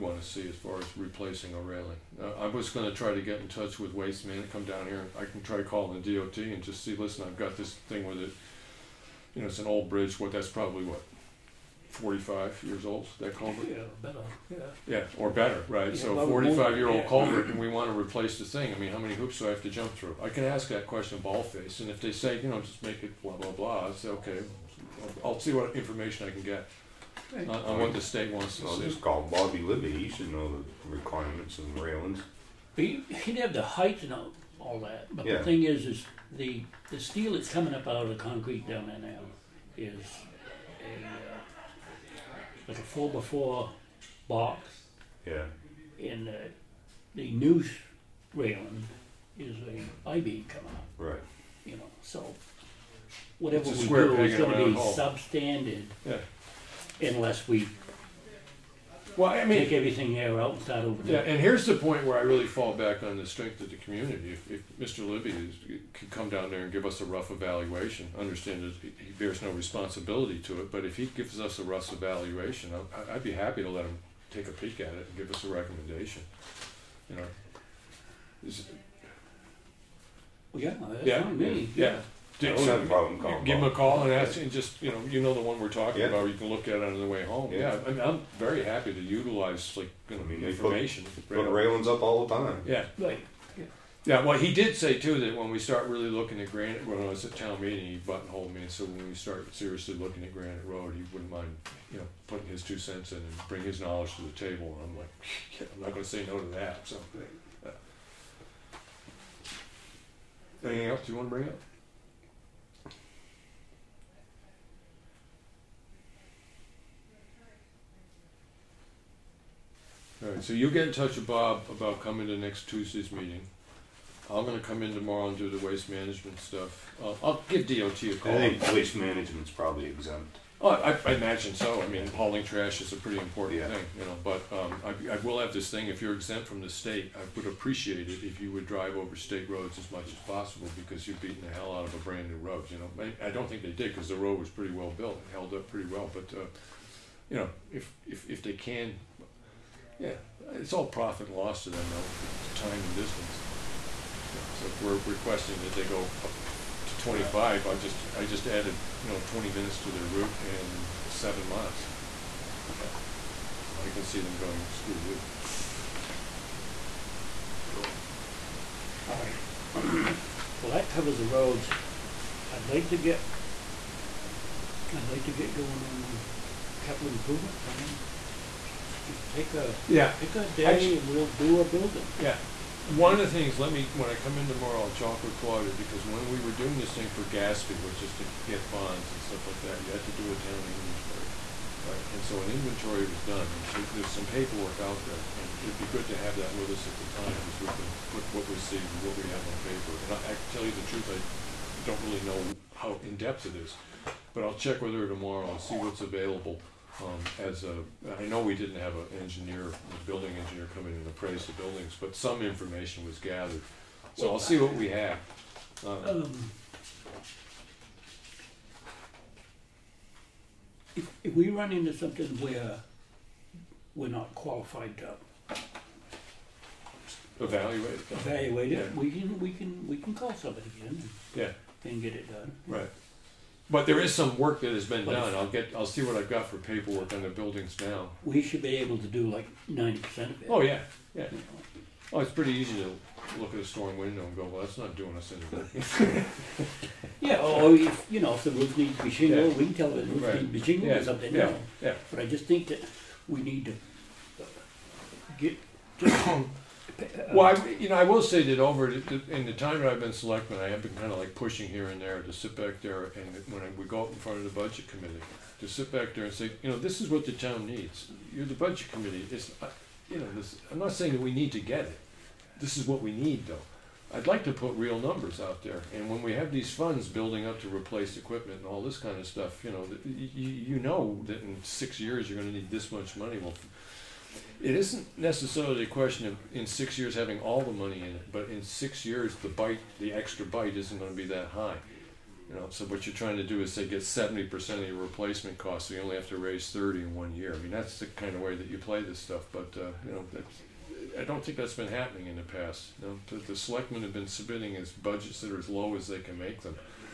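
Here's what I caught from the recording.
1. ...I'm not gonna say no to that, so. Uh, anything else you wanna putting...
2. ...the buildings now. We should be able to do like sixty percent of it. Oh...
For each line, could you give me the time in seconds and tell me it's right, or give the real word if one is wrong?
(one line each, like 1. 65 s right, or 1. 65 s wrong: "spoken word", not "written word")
1. 105 s wrong: "bring", not "putting"
2. 237 s wrong: "ninety", not "sixty".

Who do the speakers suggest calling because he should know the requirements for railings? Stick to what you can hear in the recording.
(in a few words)
Bobby Libby.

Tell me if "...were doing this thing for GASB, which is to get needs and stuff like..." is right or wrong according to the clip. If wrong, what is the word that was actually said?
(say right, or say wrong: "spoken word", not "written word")
wrong: "bonds", not "needs".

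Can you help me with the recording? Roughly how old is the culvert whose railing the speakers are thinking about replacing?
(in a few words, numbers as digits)
45 years.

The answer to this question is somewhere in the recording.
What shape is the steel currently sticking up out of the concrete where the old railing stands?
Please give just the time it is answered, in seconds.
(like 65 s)
42 s.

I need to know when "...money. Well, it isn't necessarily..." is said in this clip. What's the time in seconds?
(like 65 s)
283 s.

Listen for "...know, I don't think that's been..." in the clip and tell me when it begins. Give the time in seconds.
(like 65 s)
300 s.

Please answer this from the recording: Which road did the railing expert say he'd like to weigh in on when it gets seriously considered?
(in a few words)
Granite Road.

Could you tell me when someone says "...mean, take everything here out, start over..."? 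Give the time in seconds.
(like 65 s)
59 s.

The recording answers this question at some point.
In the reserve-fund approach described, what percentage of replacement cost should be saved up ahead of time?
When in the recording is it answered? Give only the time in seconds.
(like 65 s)
294 s.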